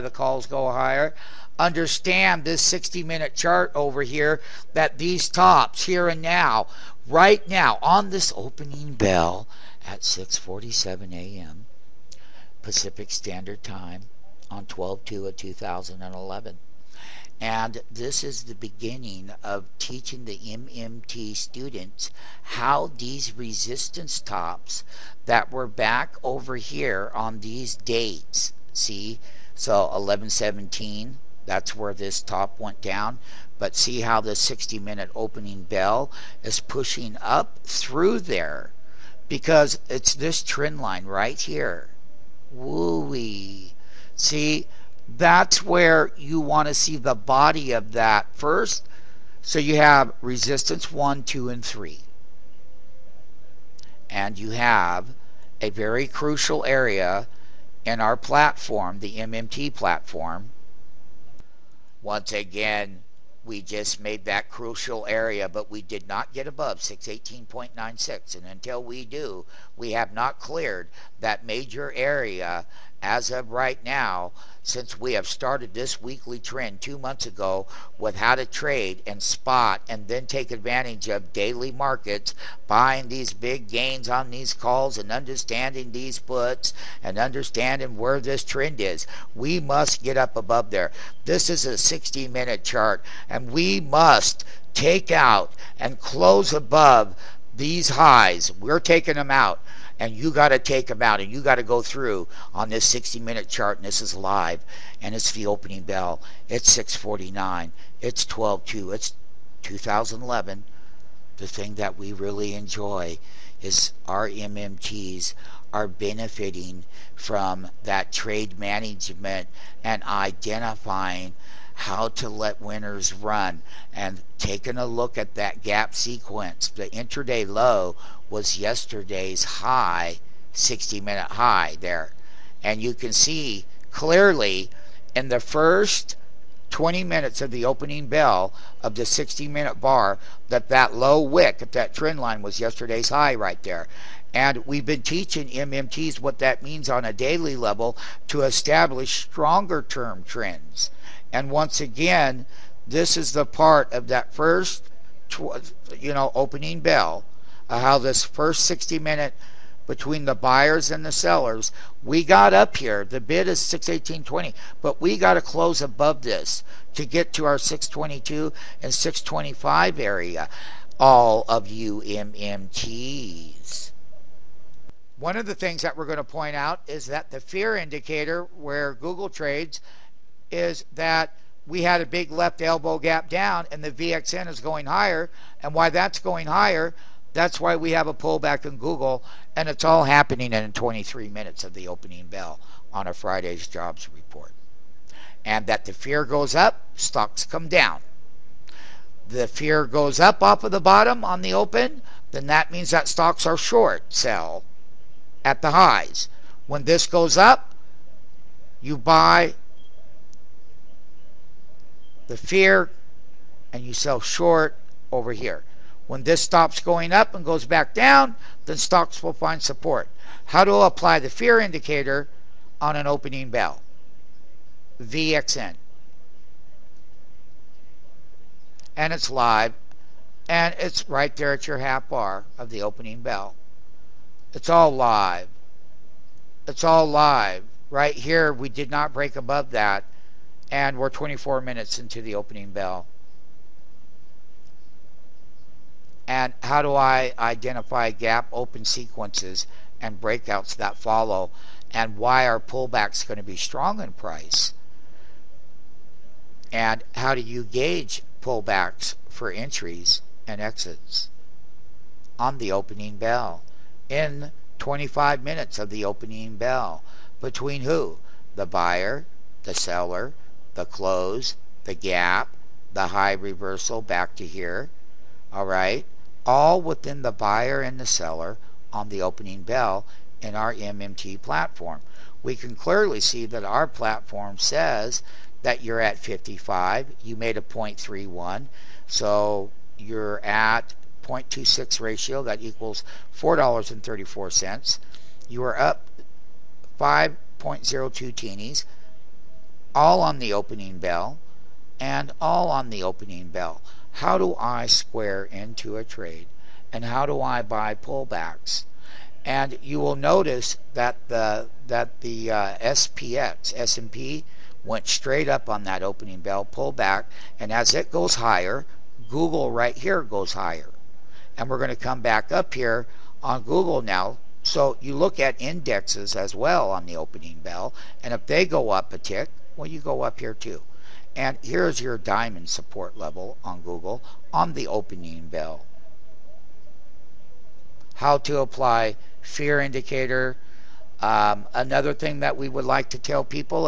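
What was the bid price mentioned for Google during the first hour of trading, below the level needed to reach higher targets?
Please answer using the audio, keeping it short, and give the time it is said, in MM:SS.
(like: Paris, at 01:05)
618.20, at 02:43.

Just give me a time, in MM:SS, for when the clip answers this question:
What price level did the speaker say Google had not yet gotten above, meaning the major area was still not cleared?
01:06.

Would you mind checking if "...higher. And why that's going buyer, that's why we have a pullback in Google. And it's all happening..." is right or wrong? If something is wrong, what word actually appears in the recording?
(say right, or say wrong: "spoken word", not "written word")
wrong: "higher", not "buyer".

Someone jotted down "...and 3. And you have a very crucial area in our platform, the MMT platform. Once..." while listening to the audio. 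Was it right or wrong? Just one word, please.
right.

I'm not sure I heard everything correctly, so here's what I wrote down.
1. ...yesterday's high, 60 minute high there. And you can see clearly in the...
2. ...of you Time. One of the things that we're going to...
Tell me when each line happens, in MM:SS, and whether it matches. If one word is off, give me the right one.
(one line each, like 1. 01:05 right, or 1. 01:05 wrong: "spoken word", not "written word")
1. 02:08 right
2. 02:51 wrong: "MMTs", not "Time".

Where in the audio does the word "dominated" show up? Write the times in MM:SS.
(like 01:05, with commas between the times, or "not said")
not said.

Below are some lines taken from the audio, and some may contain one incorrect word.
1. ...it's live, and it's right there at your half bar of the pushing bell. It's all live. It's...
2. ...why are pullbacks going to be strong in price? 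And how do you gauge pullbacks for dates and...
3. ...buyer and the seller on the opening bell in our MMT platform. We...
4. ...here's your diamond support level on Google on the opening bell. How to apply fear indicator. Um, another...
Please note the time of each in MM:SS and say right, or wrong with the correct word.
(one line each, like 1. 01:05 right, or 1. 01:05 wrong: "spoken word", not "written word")
1. 03:49 wrong: "opening", not "pushing"
2. 04:12 wrong: "entries", not "dates"
3. 04:37 right
4. 05:31 right.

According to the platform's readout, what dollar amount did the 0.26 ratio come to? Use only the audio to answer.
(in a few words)
$4.34.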